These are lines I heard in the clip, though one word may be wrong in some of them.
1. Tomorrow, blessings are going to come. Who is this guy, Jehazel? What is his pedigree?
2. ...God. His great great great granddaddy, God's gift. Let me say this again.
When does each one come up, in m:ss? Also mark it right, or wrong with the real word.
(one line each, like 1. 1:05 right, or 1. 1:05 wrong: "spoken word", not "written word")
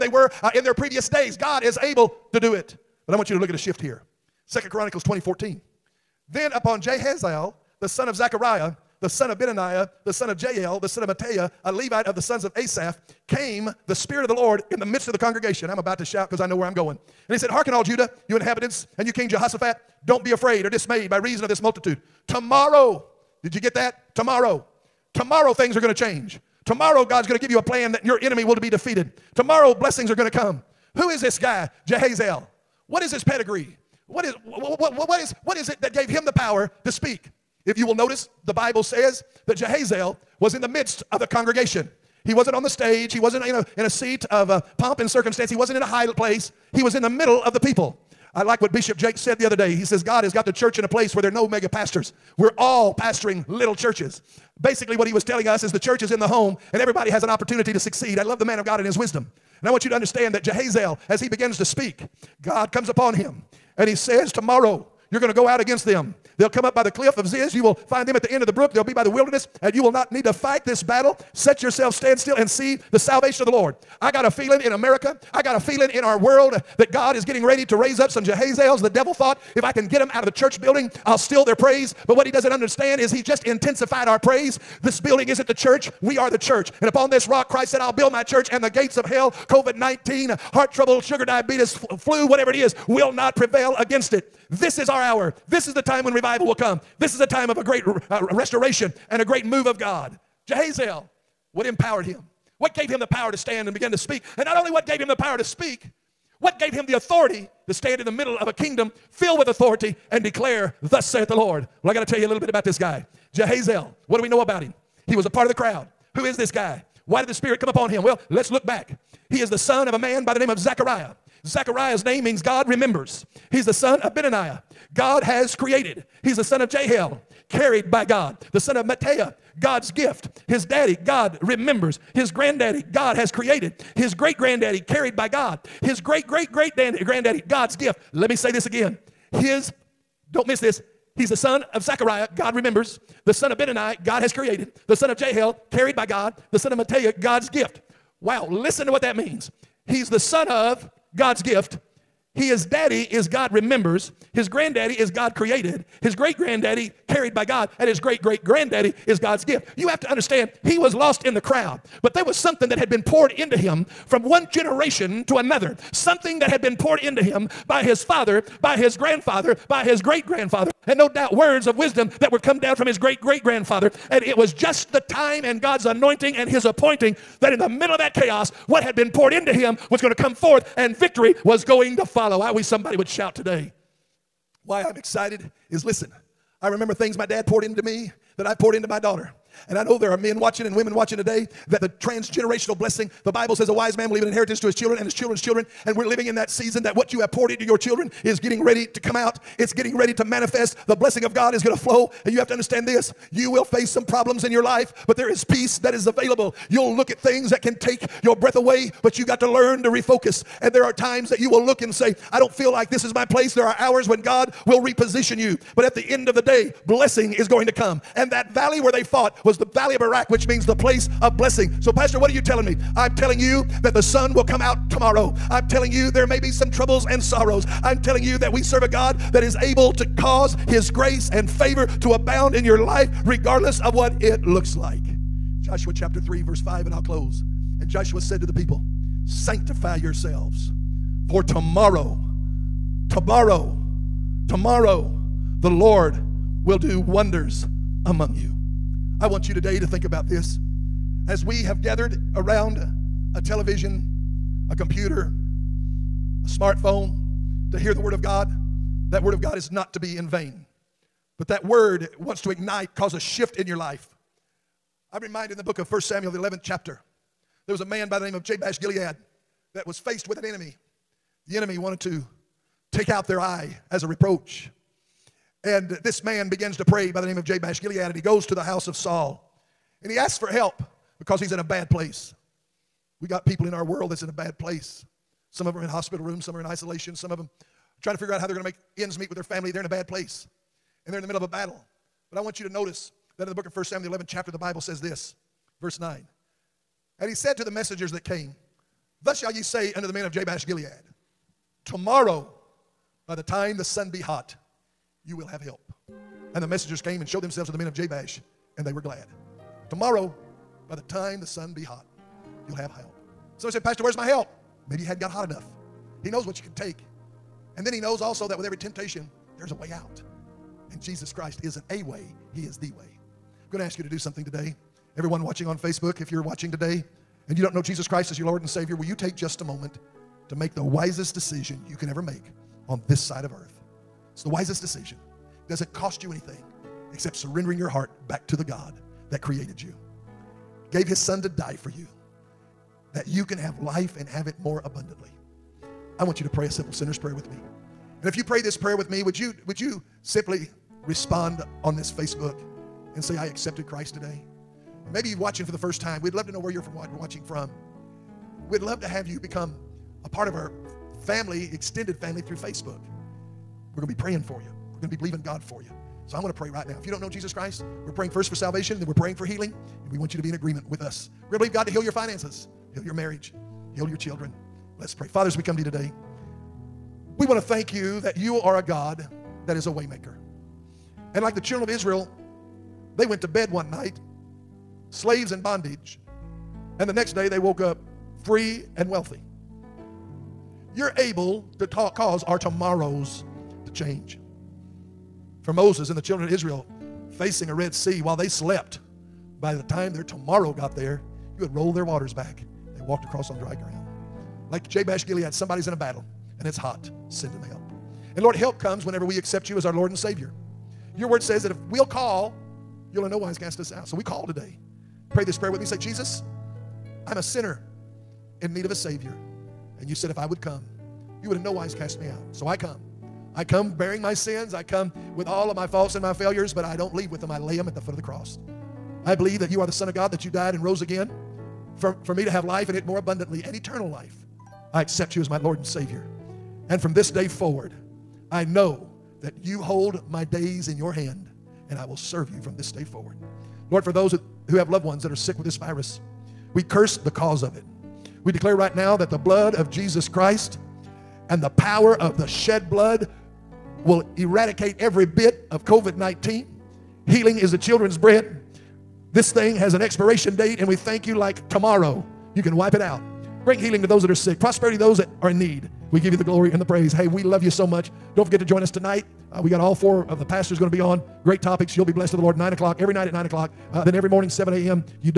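1. 0:29 right
2. 2:15 right.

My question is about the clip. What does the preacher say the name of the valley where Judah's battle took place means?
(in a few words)
the place of blessing.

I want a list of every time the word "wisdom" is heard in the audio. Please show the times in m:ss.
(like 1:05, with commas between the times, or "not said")
0:58, 2:51.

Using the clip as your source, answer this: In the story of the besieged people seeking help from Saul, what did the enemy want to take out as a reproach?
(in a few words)
their eye.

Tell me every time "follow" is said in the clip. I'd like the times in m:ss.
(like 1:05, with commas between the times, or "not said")
3:02.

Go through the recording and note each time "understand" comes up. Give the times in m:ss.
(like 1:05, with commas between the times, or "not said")
0:59, 1:22, 2:40, 3:22.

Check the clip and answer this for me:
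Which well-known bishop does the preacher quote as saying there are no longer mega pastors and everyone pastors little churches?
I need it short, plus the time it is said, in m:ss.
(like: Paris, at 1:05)
Bishop Jakes, at 0:48.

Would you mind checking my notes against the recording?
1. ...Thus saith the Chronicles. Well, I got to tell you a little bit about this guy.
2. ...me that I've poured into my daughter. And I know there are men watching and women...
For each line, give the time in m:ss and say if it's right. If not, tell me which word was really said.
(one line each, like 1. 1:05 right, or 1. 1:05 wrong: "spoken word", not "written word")
1. 1:50 wrong: "Lord", not "Chronicles"
2. 3:07 right.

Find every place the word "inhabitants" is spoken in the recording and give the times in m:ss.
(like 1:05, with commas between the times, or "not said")
0:18.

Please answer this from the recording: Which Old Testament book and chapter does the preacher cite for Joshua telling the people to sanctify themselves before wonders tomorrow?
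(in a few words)
Joshua chapter 3.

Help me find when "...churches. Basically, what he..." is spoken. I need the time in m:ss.
0:53.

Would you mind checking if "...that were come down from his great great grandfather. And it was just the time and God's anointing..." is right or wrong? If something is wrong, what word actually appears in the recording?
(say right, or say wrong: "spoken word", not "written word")
right.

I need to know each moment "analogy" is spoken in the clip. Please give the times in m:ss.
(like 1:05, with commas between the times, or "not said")
not said.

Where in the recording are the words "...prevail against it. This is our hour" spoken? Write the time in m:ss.
1:33.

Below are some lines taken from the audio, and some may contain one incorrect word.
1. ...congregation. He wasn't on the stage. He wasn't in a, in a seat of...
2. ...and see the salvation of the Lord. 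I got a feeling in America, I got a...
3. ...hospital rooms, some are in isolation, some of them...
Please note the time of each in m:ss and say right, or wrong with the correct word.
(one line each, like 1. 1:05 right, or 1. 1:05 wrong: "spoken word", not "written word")
1. 0:41 right
2. 1:12 right
3. 4:45 right.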